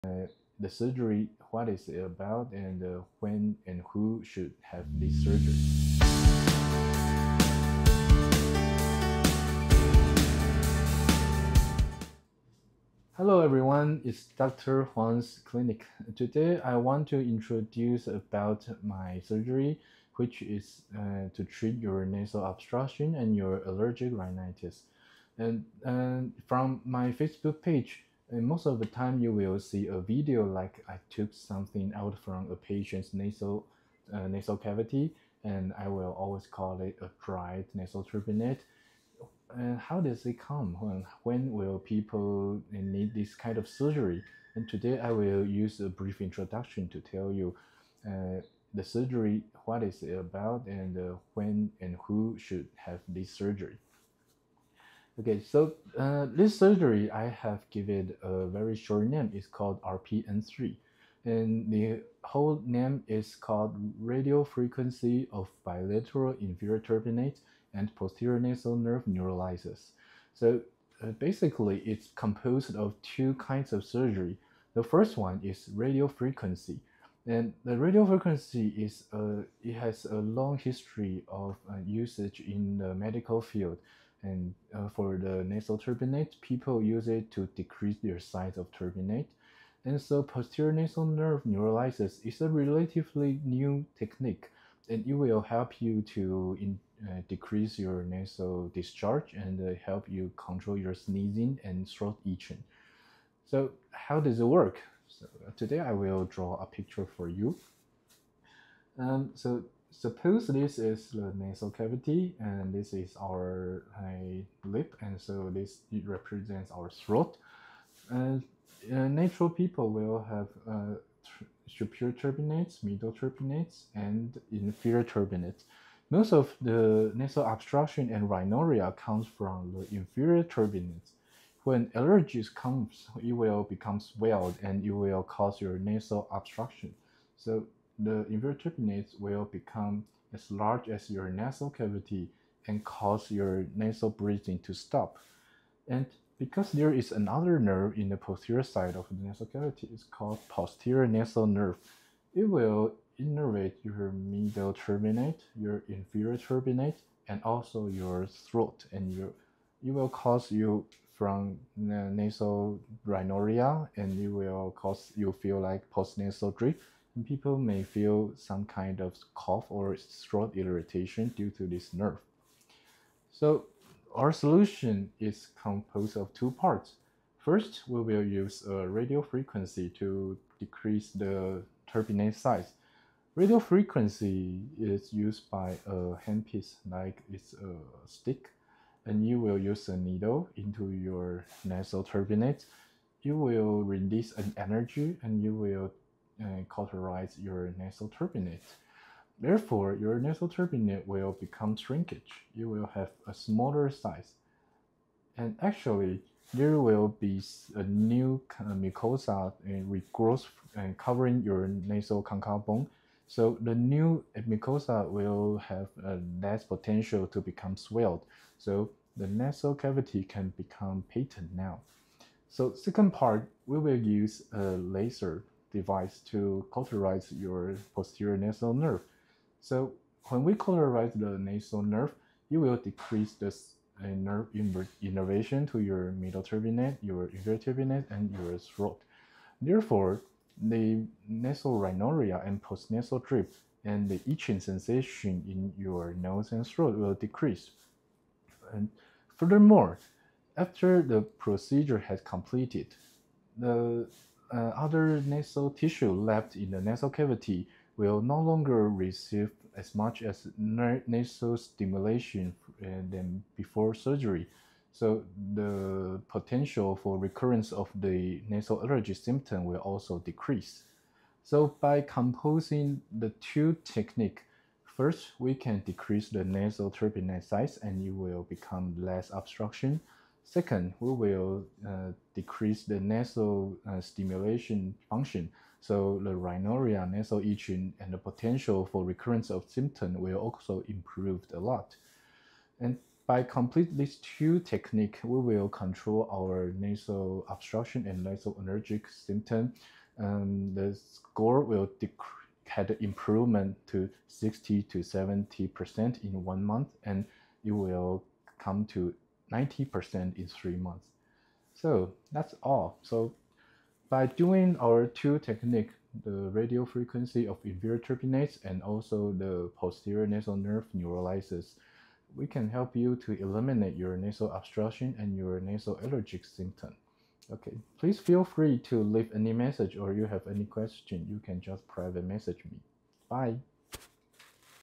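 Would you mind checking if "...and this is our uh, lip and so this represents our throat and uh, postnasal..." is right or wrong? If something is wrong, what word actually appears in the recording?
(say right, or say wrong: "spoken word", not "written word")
wrong: "natural", not "postnasal".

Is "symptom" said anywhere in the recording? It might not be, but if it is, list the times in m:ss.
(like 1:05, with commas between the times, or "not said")
4:29, 4:49, 4:59, 5:26.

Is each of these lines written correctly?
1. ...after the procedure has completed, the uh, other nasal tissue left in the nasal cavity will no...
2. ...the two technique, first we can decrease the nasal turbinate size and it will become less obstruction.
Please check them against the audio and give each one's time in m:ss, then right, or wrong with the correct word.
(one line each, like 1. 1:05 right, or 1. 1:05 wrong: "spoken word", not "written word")
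1. 4:10 right
2. 4:33 right.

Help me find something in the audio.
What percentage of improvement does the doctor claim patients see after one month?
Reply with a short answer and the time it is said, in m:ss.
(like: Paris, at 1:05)
60 to 70%, at 5:04.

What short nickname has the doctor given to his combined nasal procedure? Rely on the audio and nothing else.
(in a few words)
RPN3.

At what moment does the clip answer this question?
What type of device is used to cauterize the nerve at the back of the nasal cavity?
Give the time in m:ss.
3:44.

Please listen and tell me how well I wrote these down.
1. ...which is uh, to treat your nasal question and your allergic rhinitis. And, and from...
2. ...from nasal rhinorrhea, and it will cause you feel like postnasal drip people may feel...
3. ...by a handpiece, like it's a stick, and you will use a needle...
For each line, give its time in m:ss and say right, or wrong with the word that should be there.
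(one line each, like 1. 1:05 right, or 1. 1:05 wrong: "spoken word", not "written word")
1. 0:20 wrong: "obstruction", not "question"
2. 2:41 right
3. 3:05 right.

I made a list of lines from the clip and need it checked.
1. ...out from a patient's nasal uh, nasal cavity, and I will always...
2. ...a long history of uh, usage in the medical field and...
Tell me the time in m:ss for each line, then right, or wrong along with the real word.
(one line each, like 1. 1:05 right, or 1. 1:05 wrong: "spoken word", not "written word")
1. 0:31 right
2. 1:20 right.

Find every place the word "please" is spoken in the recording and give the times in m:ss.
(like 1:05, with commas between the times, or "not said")
5:27.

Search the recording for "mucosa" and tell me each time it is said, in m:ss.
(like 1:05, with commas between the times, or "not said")
3:28, 3:34.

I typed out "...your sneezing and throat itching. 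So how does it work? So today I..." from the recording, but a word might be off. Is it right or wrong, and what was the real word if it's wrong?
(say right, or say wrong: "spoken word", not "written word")
right.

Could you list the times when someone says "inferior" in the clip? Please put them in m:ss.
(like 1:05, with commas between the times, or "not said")
1:06, 2:04, 2:09, 2:18, 2:35, 3:57, 5:17.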